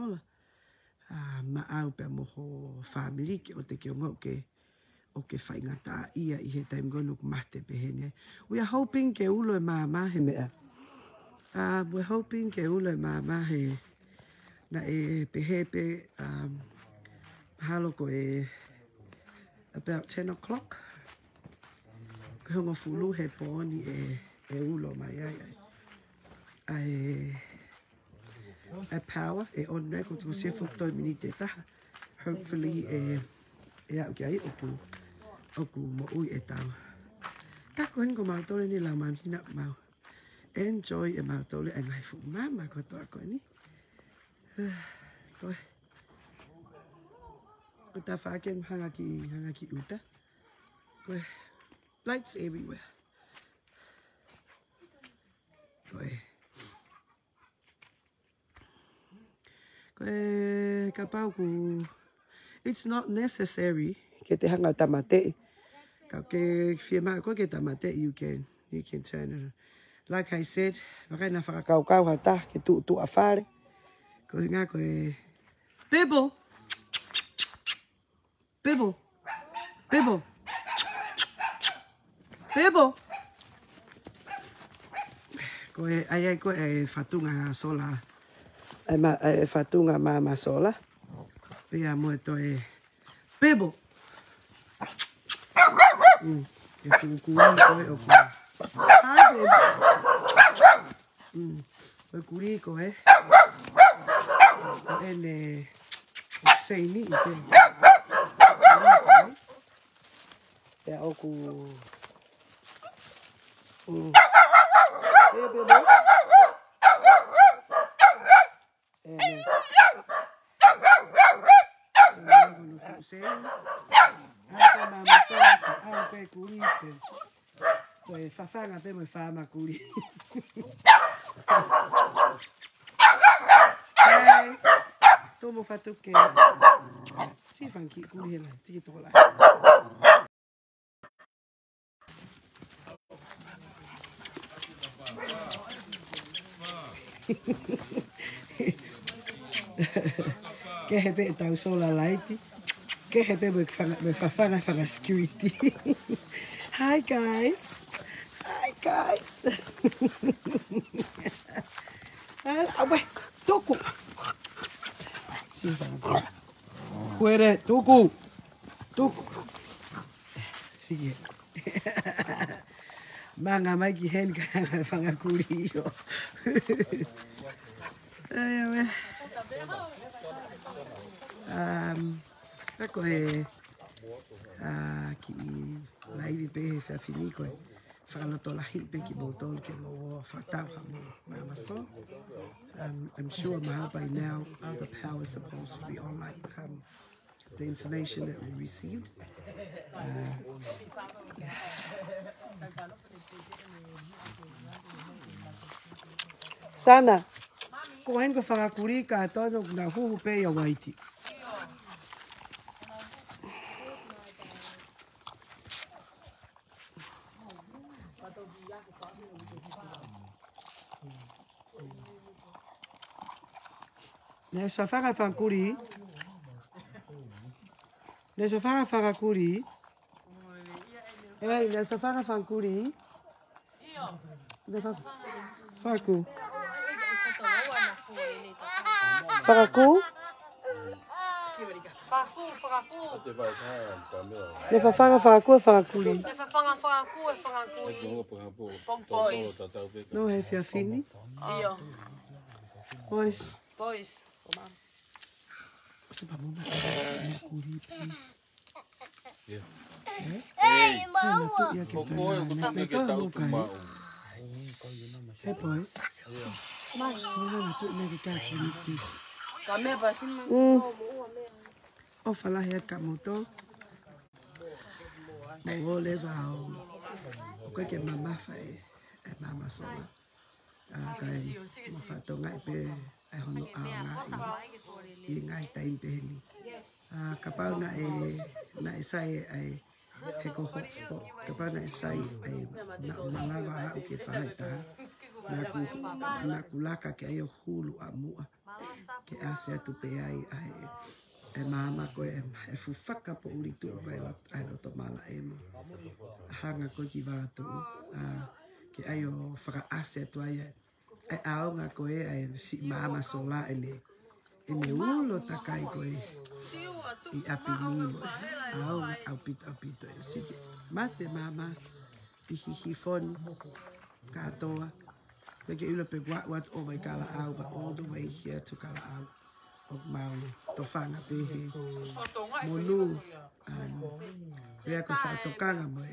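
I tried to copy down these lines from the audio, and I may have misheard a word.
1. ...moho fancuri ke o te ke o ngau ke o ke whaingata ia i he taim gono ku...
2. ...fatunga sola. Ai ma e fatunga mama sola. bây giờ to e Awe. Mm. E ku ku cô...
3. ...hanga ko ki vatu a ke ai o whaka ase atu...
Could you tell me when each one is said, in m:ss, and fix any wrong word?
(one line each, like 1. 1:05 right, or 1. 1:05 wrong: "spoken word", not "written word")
1. 0:02 wrong: "whamiri", not "fancuri"
2. 1:26 wrong: "Bebo", not "Awe"
3. 5:06 right.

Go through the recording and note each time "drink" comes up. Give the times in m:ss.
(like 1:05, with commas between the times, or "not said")
not said.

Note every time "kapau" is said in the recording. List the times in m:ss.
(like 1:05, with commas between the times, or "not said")
4:47, 4:51.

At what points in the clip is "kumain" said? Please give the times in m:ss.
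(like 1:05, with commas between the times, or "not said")
3:28.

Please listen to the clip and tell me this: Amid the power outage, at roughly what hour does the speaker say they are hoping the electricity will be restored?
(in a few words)
10 o'clock.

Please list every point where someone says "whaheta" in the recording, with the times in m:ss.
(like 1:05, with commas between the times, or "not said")
4:54.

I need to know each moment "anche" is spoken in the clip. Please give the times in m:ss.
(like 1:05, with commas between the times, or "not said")
2:17.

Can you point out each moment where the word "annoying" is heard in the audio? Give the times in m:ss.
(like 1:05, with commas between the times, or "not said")
not said.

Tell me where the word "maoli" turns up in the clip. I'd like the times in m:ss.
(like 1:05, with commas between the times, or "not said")
5:30.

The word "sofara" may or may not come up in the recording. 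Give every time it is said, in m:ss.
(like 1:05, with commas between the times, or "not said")
3:44.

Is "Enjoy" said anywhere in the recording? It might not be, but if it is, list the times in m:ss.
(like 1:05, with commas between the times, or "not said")
0:40.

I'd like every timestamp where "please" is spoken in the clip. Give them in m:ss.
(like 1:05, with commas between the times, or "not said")
4:17, 4:28.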